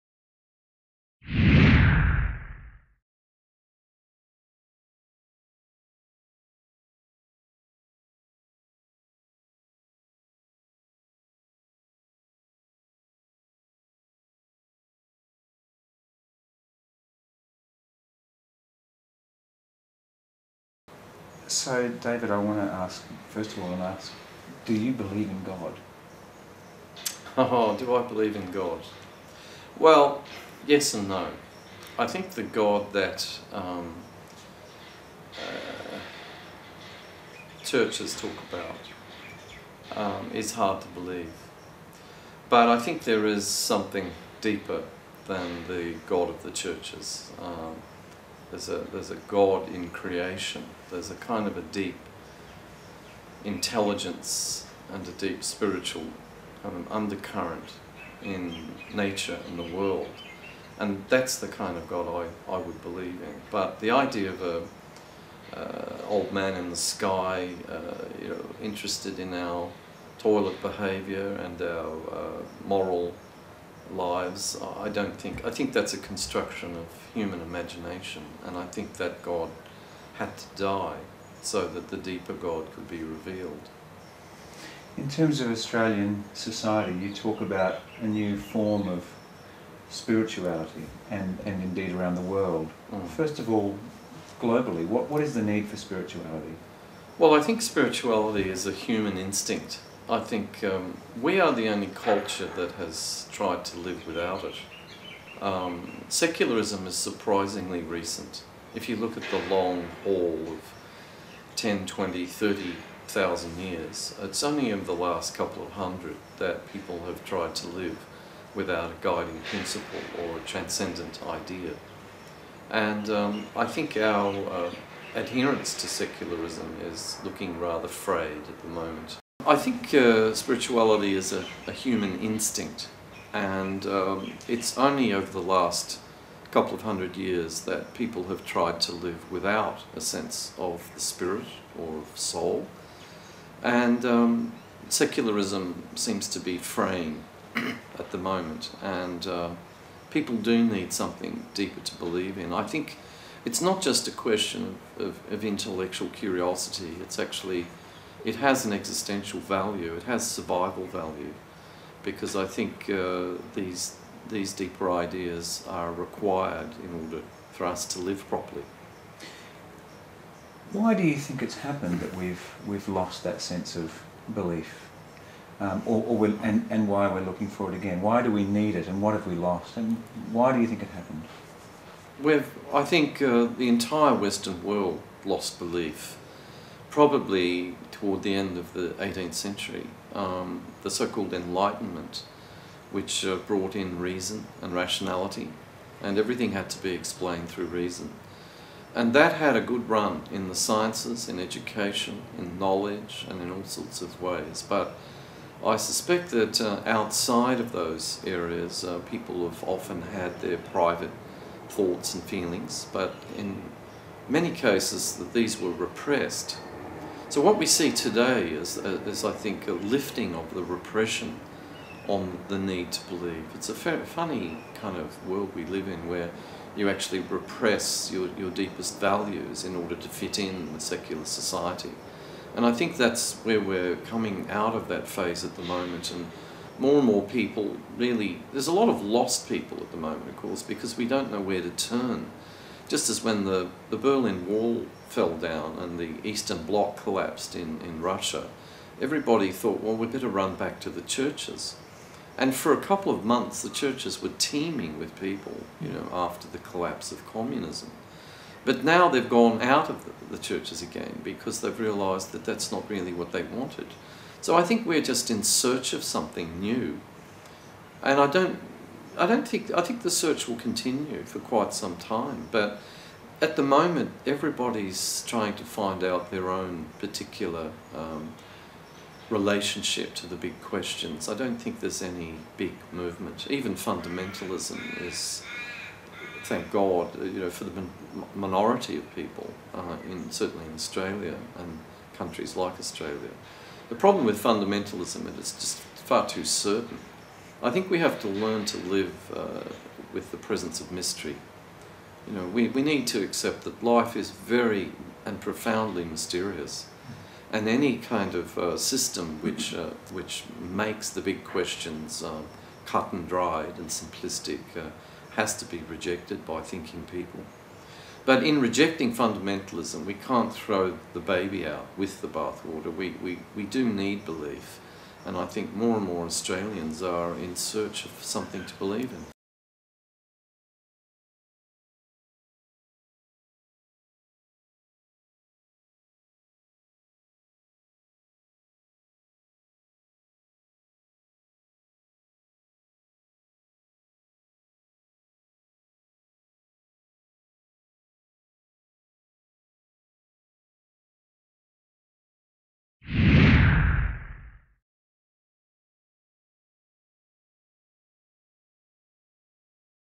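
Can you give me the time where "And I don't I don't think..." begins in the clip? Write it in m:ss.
4:28.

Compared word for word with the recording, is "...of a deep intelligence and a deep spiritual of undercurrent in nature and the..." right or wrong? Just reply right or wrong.
right.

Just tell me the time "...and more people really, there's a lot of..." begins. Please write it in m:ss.
3:56.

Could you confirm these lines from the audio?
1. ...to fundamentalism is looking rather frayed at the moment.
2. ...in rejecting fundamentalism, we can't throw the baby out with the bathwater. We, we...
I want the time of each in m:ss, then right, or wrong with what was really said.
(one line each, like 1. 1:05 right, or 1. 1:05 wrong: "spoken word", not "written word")
1. 2:05 wrong: "secularism", not "fundamentalism"
2. 5:18 right.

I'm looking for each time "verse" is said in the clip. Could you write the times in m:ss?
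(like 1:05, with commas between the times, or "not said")
not said.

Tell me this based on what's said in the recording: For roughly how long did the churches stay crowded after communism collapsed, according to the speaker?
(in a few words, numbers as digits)
A couple of months.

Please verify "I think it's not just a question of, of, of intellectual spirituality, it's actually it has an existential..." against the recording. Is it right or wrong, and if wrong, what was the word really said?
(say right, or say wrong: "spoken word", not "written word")
wrong: "curiosity", not "spirituality".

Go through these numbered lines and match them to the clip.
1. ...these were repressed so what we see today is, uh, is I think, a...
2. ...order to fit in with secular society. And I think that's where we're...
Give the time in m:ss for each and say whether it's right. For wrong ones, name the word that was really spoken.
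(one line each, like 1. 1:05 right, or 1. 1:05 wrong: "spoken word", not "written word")
1. 3:35 right
2. 3:49 right.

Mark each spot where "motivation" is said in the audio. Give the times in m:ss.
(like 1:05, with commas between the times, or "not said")
not said.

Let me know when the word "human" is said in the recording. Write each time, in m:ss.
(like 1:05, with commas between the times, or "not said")
1:17, 1:38, 2:11.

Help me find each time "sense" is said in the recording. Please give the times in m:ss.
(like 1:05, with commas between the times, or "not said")
2:20, 2:53.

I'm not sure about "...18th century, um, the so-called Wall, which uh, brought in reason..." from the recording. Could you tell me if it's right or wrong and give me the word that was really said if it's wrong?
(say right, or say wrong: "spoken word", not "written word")
wrong: "Enlightenment", not "Wall".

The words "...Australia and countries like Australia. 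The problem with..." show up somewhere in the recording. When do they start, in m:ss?
4:50.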